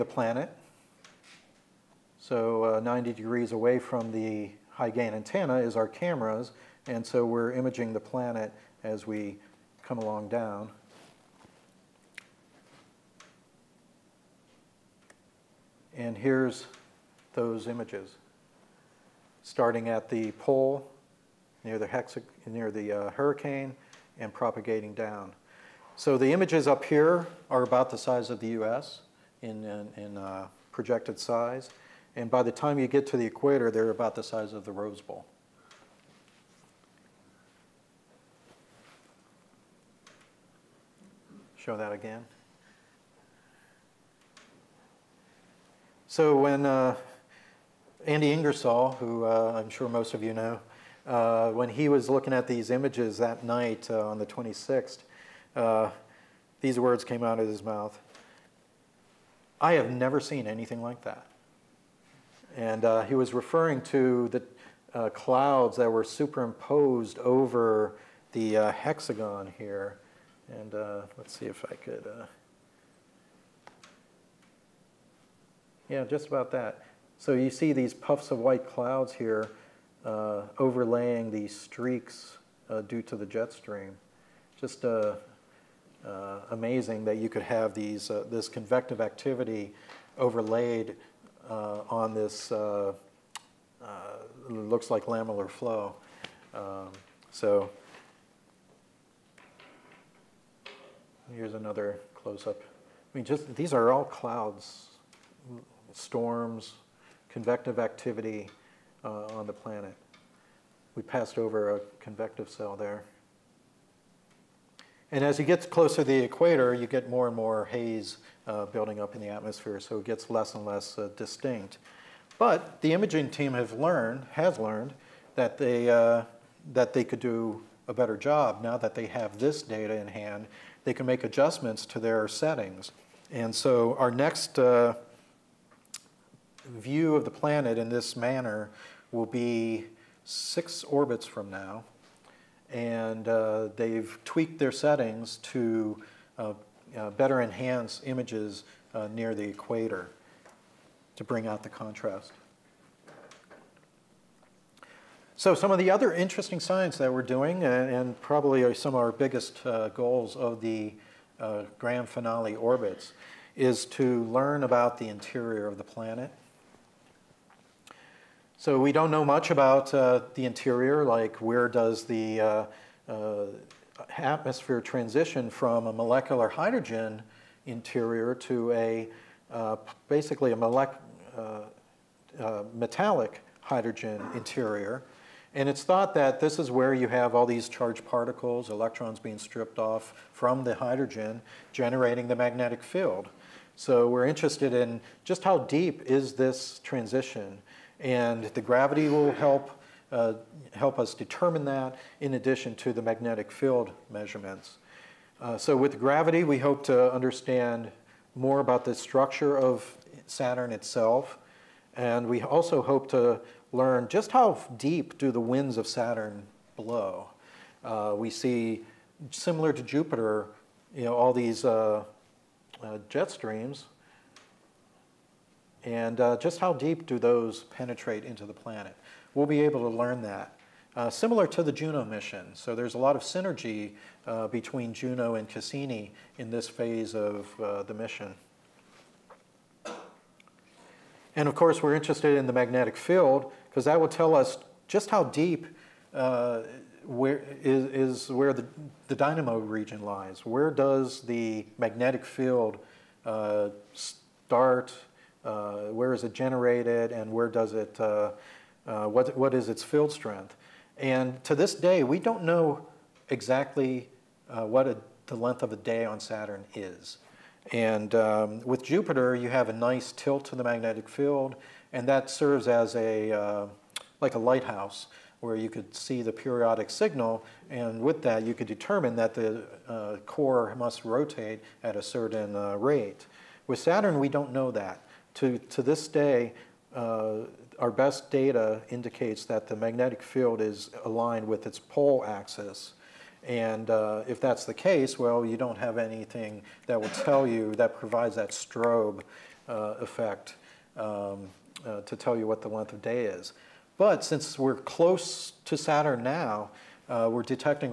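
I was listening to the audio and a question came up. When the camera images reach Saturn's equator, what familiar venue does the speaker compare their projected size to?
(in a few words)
the Rose Bowl.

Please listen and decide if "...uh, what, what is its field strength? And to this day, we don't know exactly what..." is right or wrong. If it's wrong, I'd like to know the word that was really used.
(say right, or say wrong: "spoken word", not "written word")
right.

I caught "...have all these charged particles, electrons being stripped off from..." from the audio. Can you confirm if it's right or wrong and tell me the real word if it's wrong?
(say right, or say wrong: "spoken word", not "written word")
right.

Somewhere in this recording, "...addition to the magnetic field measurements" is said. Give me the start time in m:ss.
3:22.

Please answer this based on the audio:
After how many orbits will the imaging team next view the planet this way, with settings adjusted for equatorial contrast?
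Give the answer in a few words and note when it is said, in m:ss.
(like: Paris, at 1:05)
6, at 2:20.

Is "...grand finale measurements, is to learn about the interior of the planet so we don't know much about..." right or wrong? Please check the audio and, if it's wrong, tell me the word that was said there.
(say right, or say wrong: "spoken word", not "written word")
wrong: "orbits", not "measurements".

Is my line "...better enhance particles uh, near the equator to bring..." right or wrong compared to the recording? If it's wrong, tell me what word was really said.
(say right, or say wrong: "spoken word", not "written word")
wrong: "images", not "particles".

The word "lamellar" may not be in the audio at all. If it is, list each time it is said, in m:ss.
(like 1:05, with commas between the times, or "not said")
1:35.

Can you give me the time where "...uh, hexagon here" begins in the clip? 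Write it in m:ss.
1:08.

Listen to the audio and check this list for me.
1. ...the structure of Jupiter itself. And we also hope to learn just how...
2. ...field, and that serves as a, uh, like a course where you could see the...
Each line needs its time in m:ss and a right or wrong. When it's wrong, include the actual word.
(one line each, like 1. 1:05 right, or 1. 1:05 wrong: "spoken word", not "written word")
1. 3:28 wrong: "Saturn", not "Jupiter"
2. 4:31 wrong: "lighthouse", not "course".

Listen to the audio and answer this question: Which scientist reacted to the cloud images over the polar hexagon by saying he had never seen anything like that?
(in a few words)
Andy Ingersoll.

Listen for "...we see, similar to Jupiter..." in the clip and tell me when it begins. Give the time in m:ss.
3:38.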